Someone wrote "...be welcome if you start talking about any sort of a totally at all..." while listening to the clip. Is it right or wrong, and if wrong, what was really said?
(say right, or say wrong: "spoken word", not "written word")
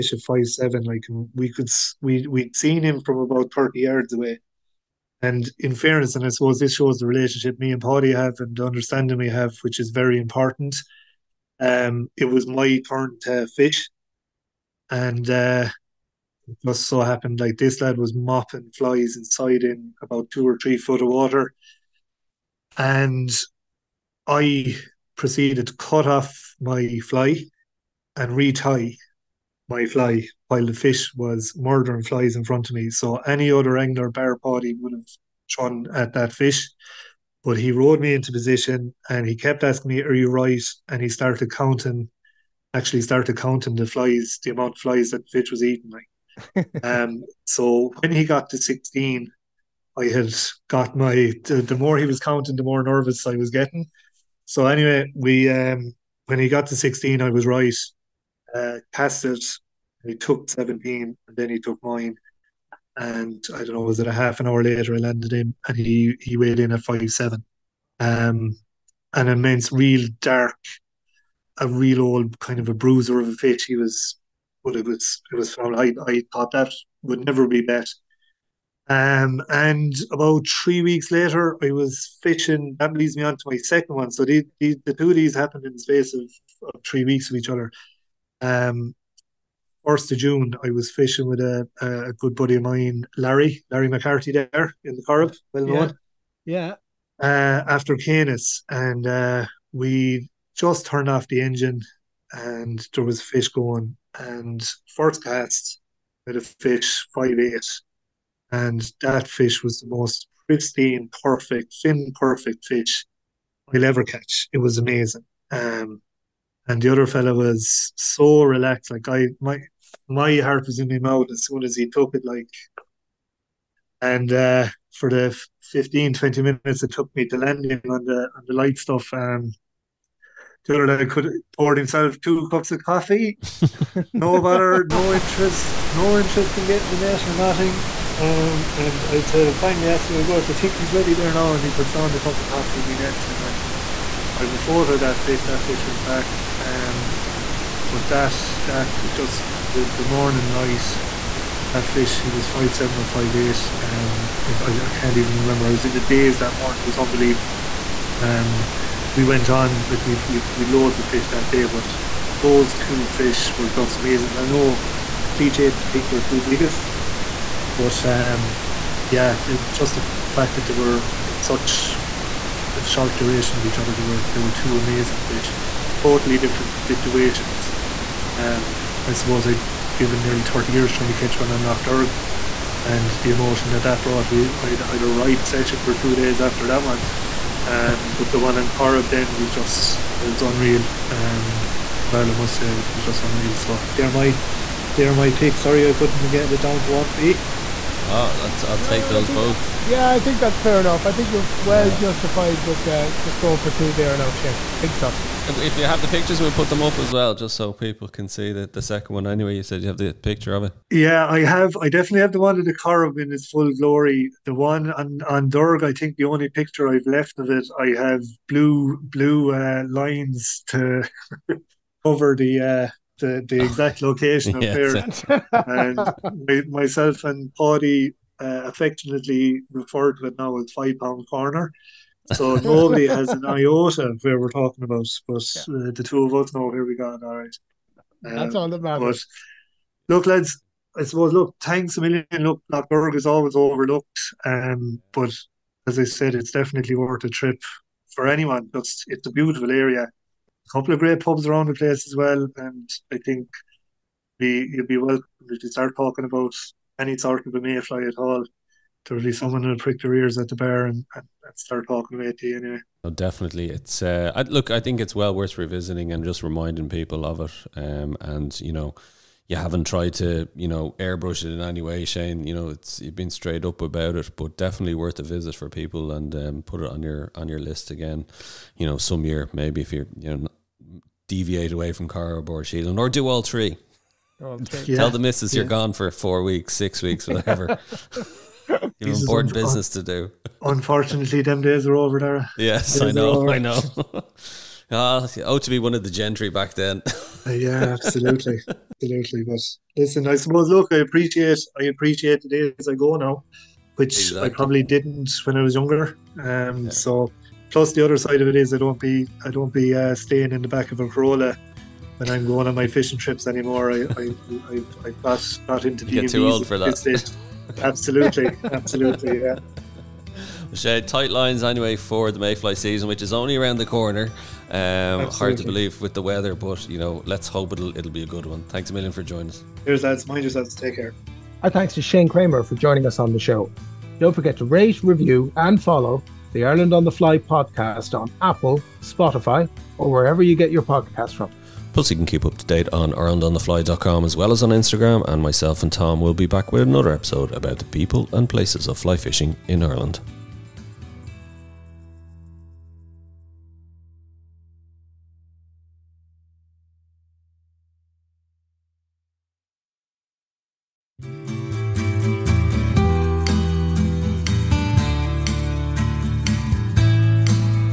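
wrong: "mayfly", not "totally".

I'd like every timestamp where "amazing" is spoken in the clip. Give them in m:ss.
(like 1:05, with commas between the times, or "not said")
1:54, 2:43, 2:54.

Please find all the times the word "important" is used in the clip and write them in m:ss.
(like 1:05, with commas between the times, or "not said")
0:10, 4:49.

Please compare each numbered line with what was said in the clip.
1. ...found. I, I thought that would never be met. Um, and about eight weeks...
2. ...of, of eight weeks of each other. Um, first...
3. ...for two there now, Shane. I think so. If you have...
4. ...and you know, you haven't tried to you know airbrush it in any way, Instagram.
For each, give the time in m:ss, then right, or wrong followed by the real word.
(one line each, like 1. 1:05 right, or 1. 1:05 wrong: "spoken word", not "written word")
1. 1:15 wrong: "three", not "eight"
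2. 1:26 wrong: "three", not "eight"
3. 3:23 right
4. 4:28 wrong: "Shane", not "Instagram".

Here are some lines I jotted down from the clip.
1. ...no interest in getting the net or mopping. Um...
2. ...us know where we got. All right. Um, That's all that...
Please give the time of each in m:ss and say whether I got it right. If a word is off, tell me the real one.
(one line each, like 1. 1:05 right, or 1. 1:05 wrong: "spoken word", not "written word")
1. 2:15 wrong: "nothing", not "mopping"
2. 3:56 right.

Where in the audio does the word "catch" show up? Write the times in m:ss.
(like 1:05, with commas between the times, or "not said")
1:54, 3:01.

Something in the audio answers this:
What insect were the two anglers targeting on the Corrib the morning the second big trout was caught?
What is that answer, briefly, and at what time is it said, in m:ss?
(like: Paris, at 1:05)
caenis, at 1:37.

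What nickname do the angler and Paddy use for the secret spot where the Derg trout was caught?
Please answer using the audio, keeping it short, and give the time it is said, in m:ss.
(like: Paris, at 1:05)
Five Pound Corner, at 3:50.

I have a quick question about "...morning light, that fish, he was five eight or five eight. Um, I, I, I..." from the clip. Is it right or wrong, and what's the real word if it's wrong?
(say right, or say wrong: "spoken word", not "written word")
wrong: "seven", not "eight".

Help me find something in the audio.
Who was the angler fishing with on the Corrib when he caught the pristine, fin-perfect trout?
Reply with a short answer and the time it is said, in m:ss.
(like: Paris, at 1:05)
Larry McCarthy, at 1:33.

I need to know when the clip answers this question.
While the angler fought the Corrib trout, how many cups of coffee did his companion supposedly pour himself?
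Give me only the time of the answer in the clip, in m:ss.
2:12.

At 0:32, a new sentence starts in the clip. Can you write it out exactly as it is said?
So any other angler bear body would have shone at that fish.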